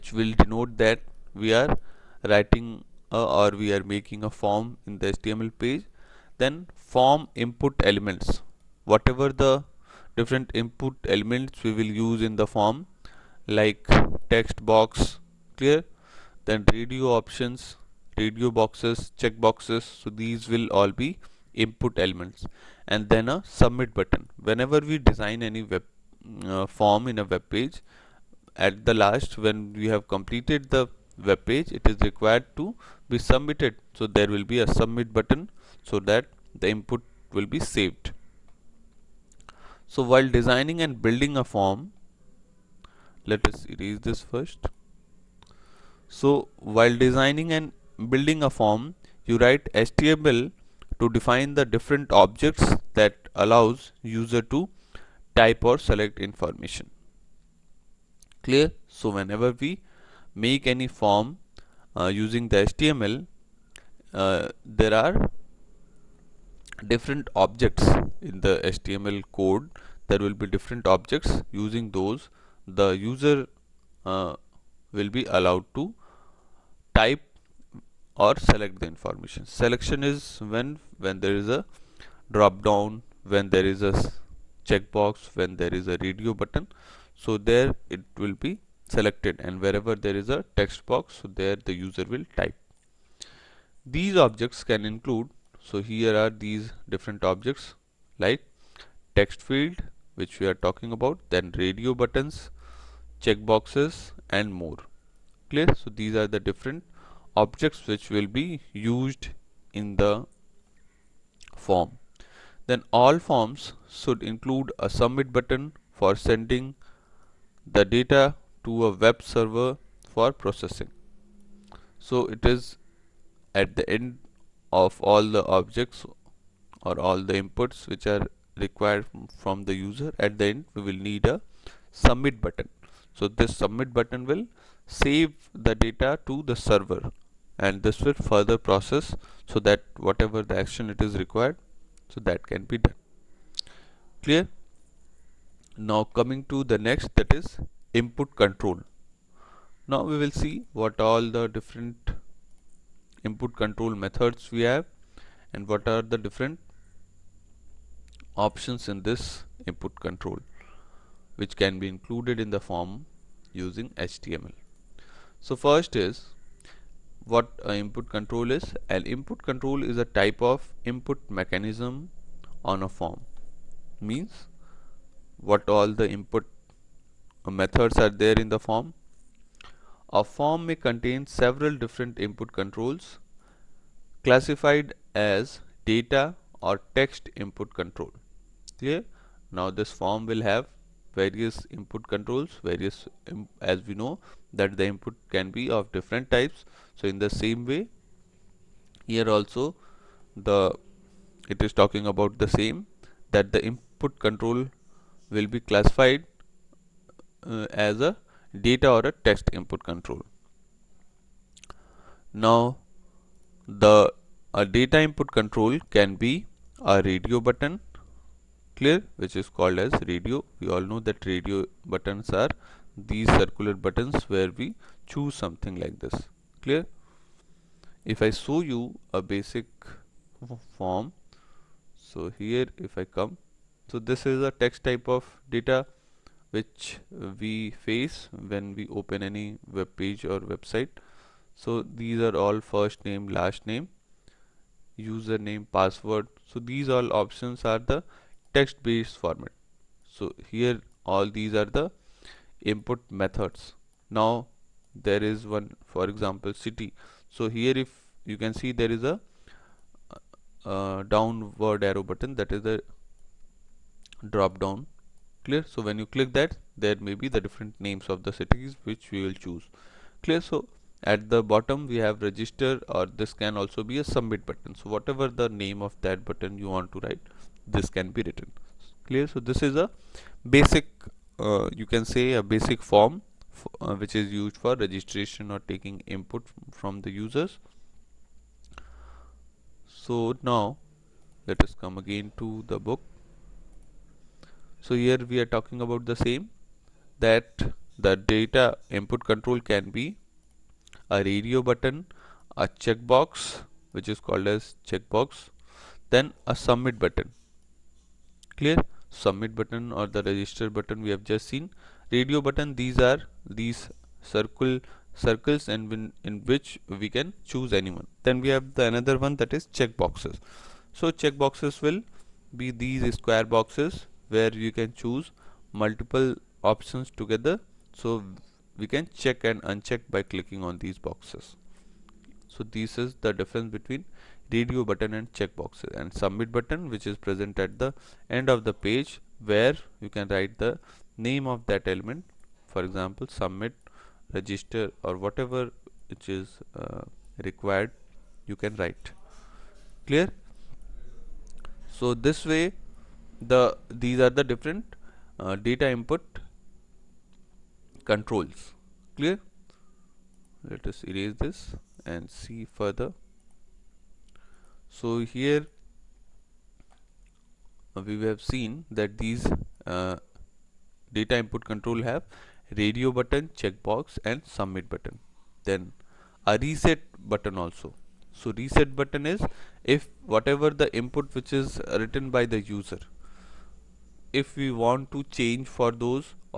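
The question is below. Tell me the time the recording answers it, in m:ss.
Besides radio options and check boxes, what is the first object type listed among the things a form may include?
1:39.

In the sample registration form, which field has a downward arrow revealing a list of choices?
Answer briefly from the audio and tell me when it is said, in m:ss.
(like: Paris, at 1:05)
City, at 4:16.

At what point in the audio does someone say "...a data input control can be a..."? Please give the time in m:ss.
3:34.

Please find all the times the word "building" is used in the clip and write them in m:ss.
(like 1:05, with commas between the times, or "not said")
0:41, 0:48.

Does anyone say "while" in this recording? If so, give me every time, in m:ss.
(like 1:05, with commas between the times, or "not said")
0:40, 0:46.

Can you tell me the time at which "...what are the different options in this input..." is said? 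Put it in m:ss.
2:35.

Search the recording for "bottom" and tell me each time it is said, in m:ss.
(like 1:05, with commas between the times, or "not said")
4:31.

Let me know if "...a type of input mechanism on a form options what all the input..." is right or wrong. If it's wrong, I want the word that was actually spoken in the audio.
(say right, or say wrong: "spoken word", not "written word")
wrong: "means", not "options".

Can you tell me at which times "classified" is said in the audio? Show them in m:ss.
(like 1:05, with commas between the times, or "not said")
3:04, 3:25.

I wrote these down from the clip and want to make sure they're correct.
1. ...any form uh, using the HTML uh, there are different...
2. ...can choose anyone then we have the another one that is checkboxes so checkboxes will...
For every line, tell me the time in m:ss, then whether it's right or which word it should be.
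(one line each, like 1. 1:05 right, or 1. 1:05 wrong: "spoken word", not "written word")
1. 1:00 right
2. 5:17 right.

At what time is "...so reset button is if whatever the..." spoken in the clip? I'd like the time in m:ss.
6:18.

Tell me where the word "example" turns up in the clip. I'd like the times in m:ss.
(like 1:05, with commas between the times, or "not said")
4:16, 5:42.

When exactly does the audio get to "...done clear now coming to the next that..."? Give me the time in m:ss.
2:22.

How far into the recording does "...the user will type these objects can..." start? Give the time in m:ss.
1:31.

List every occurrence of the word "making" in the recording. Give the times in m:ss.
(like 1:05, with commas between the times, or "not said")
0:03.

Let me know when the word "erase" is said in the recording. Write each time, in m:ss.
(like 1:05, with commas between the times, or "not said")
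0:43, 6:01.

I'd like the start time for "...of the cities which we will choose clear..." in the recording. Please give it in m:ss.
4:28.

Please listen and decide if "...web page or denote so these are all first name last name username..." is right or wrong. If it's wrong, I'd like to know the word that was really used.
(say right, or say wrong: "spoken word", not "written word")
wrong: "website", not "denote".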